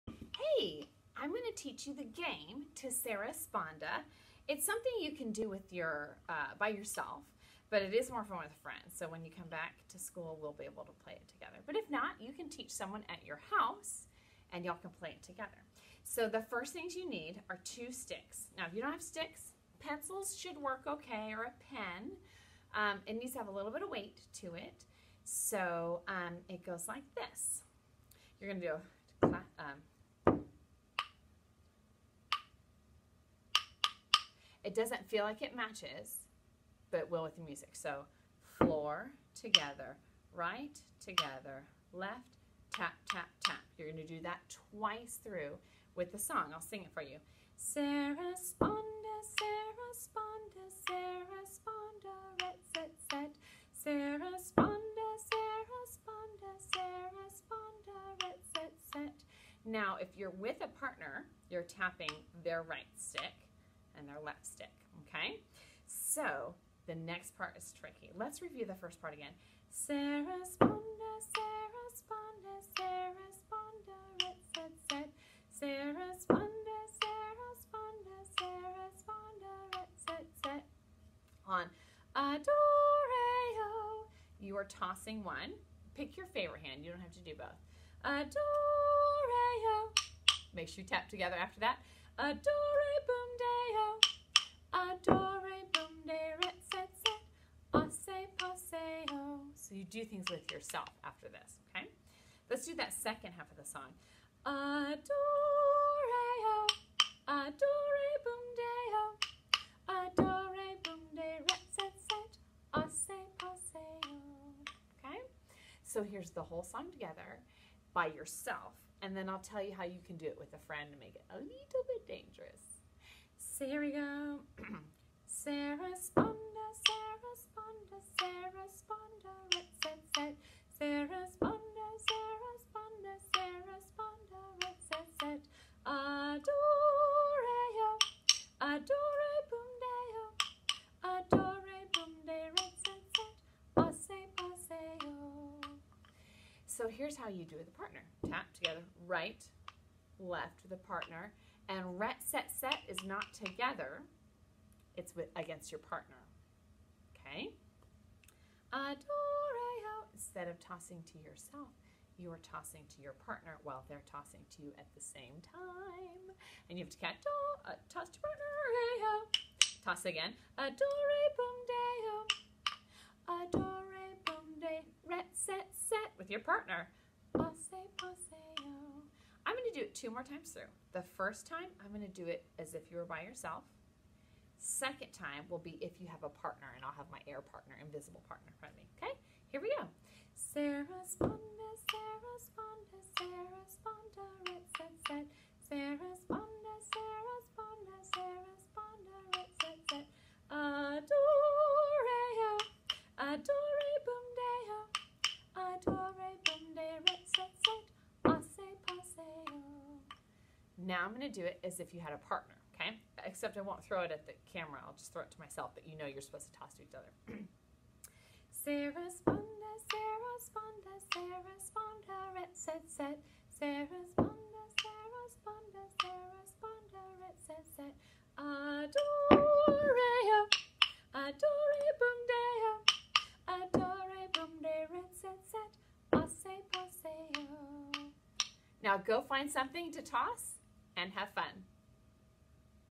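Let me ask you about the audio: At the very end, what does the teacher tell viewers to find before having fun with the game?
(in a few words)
Something to toss.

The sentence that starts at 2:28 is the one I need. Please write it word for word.
Tap together, right, left, the partner.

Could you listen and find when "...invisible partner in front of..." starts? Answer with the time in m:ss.
3:07.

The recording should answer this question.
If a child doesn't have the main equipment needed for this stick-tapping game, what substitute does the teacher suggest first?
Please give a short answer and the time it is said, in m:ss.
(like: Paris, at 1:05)
Pencils, at 0:19.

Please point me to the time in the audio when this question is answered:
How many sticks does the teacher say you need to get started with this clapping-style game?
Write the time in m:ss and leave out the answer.
0:17.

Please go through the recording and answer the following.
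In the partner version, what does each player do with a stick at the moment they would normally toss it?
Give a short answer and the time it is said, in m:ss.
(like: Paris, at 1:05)
Toss to partner, at 2:47.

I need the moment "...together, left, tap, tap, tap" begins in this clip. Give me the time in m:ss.
0:41.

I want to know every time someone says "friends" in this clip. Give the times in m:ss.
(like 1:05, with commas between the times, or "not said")
0:08, 2:00.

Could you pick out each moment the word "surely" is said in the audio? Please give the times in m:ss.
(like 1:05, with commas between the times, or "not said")
not said.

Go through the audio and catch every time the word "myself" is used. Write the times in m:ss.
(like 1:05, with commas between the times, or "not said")
3:35.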